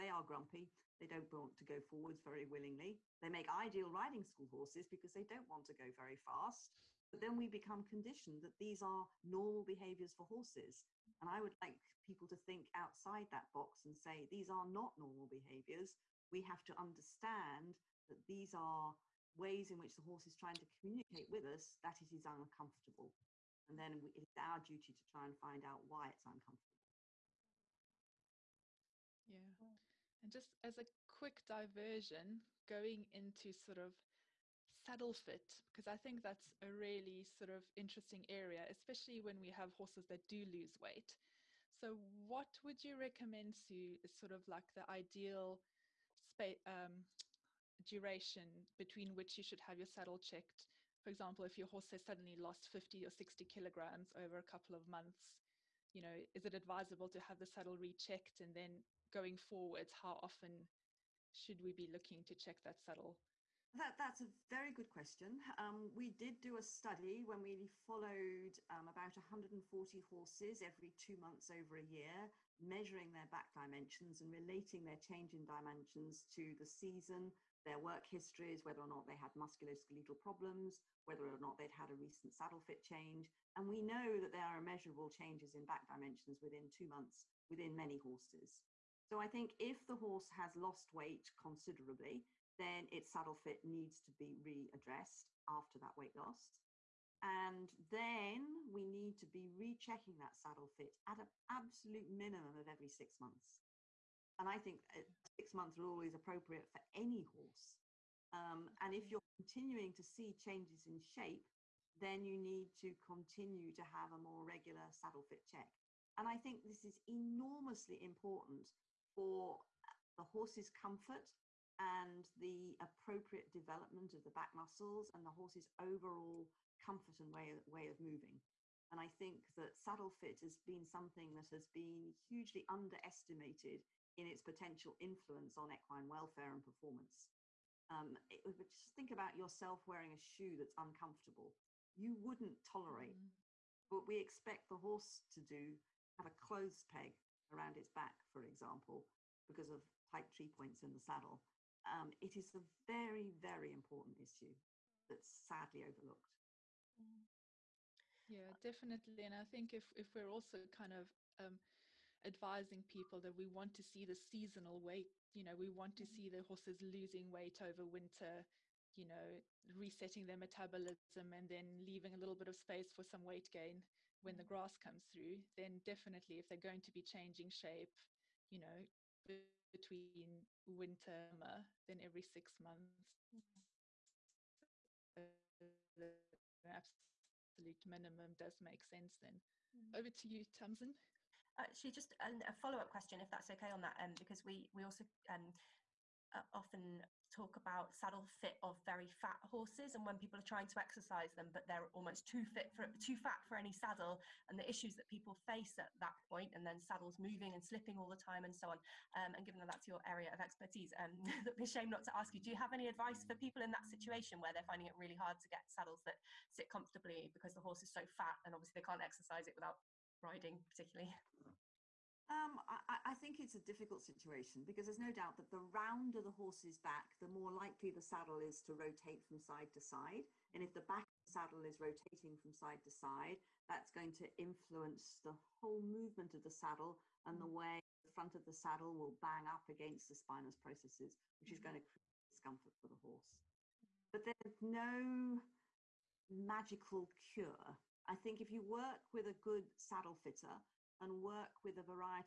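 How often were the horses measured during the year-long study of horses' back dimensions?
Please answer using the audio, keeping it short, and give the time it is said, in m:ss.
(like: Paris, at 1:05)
every two months, at 1:10.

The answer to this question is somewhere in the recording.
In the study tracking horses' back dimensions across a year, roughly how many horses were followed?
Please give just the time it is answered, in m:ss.
1:09.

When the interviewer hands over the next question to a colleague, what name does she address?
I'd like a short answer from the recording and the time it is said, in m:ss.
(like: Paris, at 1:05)
Tamsin, at 3:10.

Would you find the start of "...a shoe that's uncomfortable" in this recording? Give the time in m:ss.
2:20.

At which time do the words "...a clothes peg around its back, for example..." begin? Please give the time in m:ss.
2:26.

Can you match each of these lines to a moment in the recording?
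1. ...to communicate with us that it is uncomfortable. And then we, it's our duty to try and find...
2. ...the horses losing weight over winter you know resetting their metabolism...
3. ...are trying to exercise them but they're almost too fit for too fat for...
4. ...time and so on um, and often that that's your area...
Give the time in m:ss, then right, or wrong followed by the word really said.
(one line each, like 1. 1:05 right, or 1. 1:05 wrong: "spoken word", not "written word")
1. 0:20 right
2. 2:46 right
3. 3:20 right
4. 3:28 wrong: "given", not "often".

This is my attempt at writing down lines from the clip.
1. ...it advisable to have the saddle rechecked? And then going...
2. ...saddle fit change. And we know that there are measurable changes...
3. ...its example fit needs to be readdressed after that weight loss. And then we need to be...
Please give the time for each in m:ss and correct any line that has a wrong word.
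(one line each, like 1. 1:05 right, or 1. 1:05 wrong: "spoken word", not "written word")
1. 0:56 right
2. 1:22 right
3. 1:32 wrong: "saddle", not "example".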